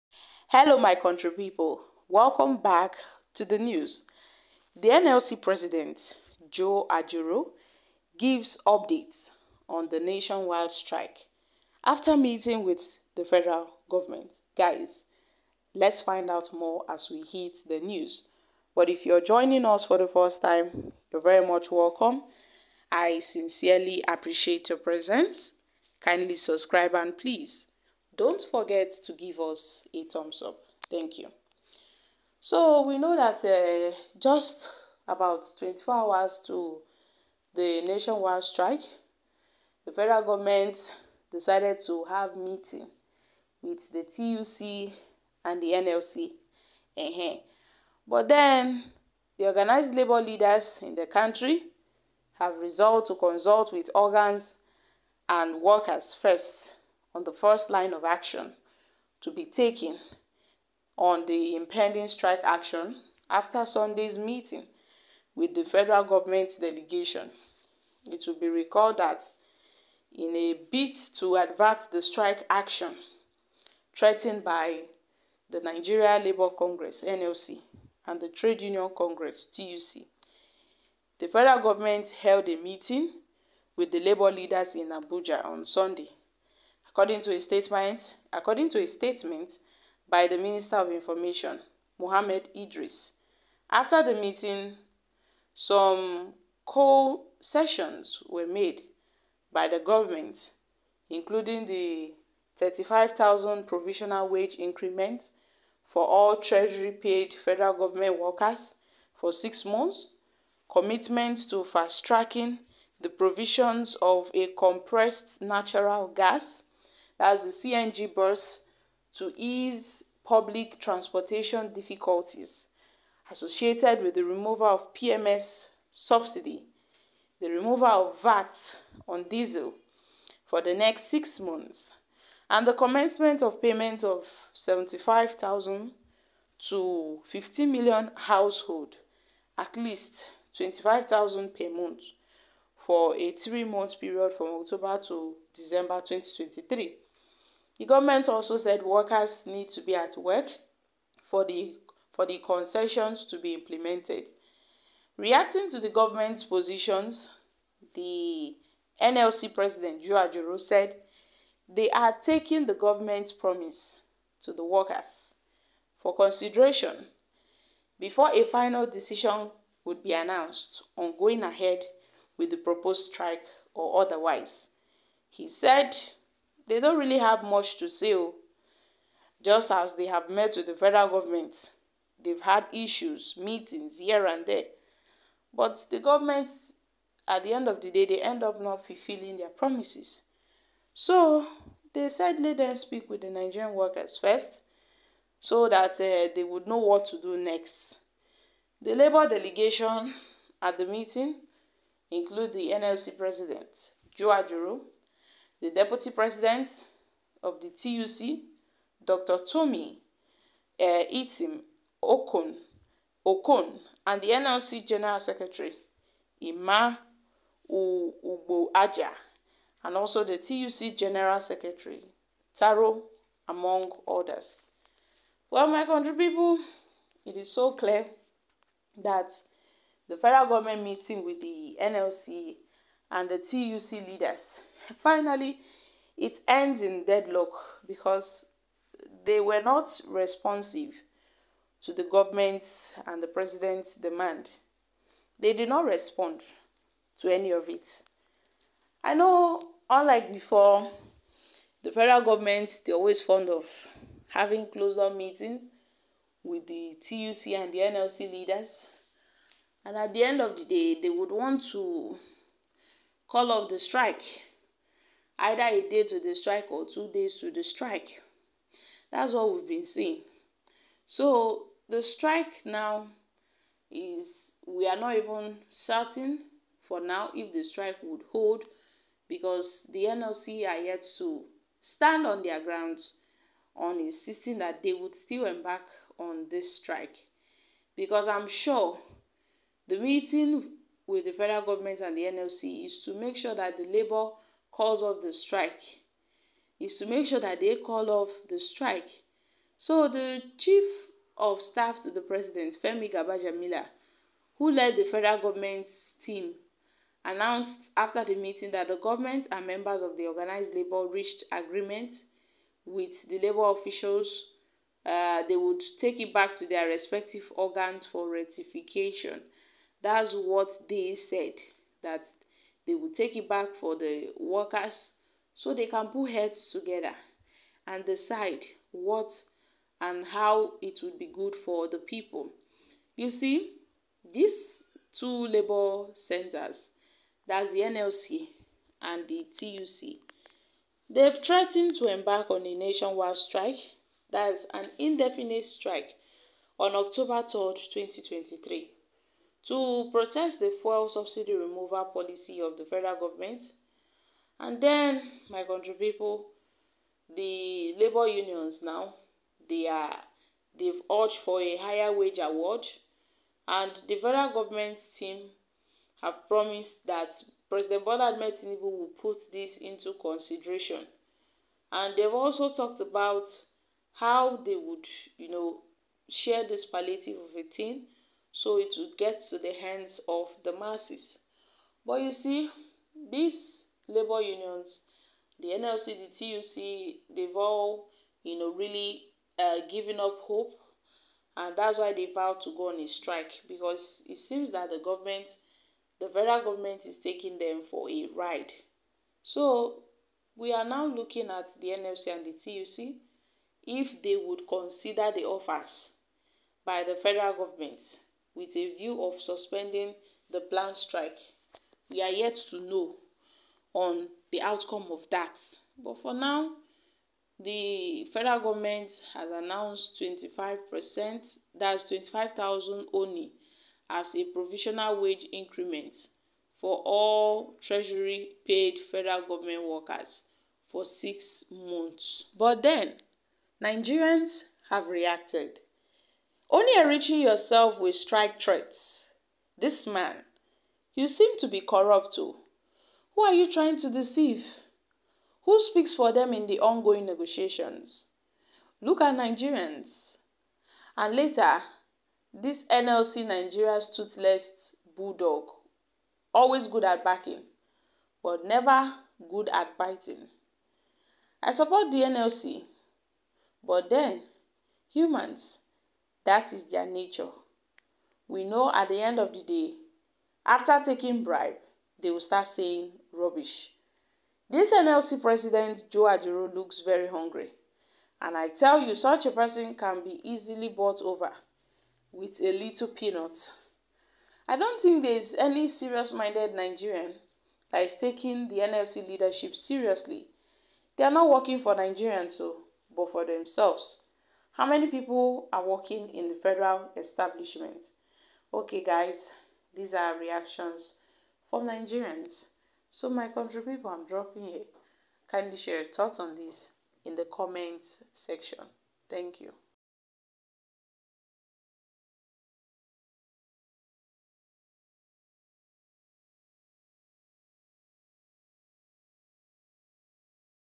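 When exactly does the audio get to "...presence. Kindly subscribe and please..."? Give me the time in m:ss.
0:24.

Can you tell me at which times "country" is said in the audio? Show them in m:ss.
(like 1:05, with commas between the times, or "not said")
0:00, 0:51, 3:45, 5:55, 8:23.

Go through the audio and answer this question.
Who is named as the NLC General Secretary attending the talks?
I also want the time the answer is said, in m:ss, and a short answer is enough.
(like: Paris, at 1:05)
Ima Ugboaja, at 3:36.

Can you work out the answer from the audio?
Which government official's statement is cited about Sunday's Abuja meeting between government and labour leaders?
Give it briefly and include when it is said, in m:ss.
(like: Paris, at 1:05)
Mohammed Idris, at 1:31.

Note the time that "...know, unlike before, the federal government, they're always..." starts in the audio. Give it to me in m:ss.
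4:09.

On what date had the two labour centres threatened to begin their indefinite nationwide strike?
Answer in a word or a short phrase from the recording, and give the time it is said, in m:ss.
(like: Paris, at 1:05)
October 3rd, 2023, at 5:46.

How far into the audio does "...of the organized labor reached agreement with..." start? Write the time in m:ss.
5:10.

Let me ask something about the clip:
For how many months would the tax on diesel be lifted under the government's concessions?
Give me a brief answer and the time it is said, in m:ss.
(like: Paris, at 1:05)
6 months, at 2:10.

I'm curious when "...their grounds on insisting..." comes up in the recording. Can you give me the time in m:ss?
4:42.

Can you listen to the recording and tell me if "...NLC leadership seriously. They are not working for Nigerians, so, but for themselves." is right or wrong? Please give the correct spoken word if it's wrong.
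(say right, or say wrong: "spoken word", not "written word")
right.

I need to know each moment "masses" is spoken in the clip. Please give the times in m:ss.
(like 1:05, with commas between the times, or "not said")
6:20.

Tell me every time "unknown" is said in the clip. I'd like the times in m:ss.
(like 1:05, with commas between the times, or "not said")
not said.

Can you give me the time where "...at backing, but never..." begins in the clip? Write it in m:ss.
7:37.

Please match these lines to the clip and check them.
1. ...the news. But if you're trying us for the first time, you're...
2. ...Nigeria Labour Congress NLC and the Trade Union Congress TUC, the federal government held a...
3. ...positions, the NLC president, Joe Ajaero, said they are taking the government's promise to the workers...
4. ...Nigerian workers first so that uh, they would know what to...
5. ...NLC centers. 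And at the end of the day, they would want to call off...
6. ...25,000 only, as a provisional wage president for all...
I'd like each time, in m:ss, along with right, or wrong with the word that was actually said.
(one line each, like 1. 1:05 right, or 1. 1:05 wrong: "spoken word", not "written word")
1. 0:17 wrong: "joining", not "trying"
2. 1:15 right
3. 2:36 right
4. 3:13 right
5. 4:17 wrong: "leaders", not "centers"
6. 7:02 wrong: "increment", not "president".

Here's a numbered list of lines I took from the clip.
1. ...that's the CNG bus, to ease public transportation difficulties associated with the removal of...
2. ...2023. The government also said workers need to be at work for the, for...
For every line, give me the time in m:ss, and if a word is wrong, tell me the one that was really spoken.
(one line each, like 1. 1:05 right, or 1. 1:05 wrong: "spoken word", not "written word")
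1. 1:57 right
2. 2:26 right.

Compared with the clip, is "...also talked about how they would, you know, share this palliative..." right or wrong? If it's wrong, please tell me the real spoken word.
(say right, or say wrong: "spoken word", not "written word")
right.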